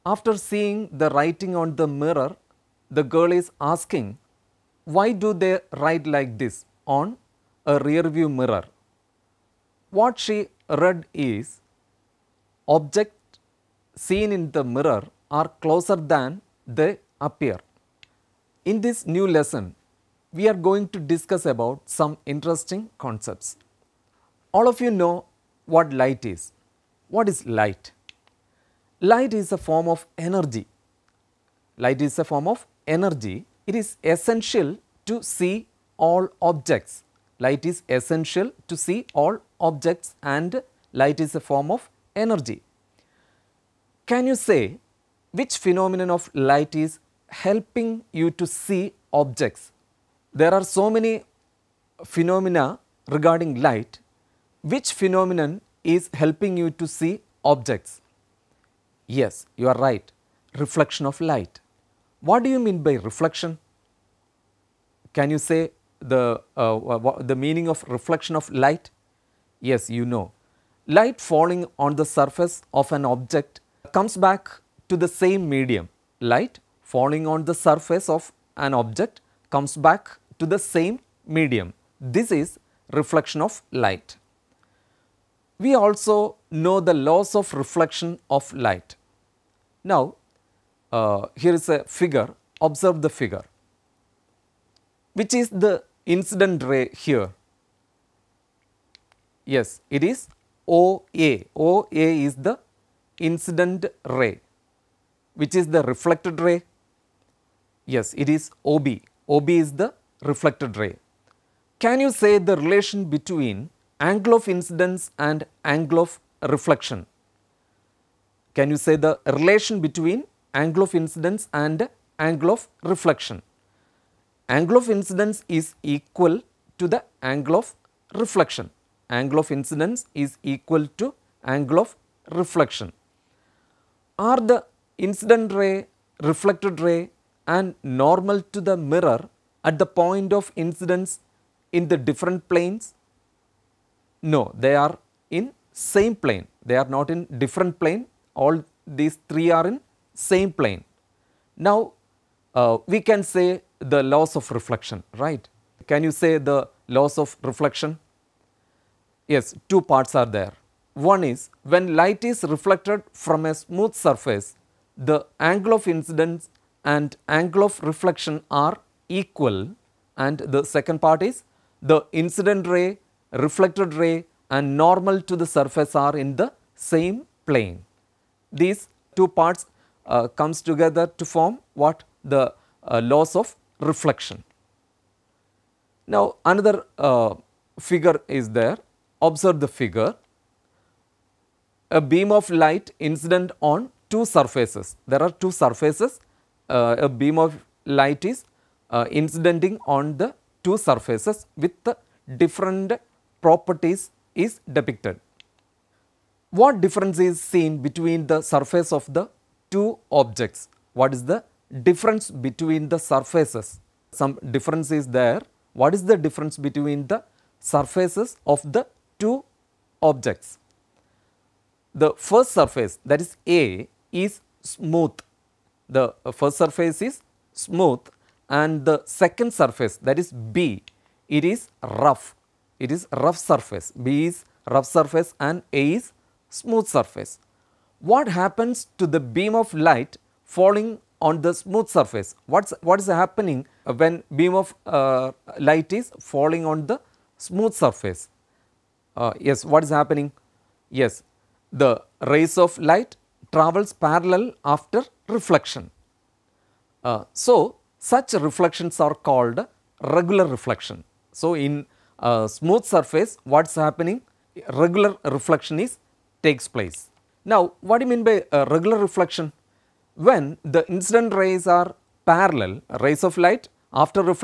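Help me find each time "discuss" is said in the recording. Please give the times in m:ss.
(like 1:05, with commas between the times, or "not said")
0:20.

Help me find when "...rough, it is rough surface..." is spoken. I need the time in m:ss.
3:51.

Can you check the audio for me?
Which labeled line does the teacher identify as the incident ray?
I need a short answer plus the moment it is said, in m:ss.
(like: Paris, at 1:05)
OA, at 1:39.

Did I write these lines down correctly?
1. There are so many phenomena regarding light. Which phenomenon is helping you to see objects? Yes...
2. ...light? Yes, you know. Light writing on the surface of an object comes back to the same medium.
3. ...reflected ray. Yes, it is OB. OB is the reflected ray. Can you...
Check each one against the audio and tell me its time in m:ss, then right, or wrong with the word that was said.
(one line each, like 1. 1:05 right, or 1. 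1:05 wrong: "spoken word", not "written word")
1. 0:50 right
2. 1:08 wrong: "falling", not "writing"
3. 1:45 right.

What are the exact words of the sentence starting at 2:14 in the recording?
Are the incident ray, reflected ray and normal to the mirror at the point of incidence in the different planes?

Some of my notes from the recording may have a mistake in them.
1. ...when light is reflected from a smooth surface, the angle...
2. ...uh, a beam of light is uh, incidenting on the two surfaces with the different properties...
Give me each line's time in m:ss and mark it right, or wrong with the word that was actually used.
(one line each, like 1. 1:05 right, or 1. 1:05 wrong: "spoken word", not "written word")
1. 2:41 right
2. 3:16 right.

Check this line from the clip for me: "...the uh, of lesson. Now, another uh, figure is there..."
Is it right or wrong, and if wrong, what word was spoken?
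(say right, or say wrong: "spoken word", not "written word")
wrong: "reflection", not "lesson".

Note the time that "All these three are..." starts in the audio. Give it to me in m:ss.
2:28.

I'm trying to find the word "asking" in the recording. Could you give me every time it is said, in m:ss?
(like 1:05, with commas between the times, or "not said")
0:03.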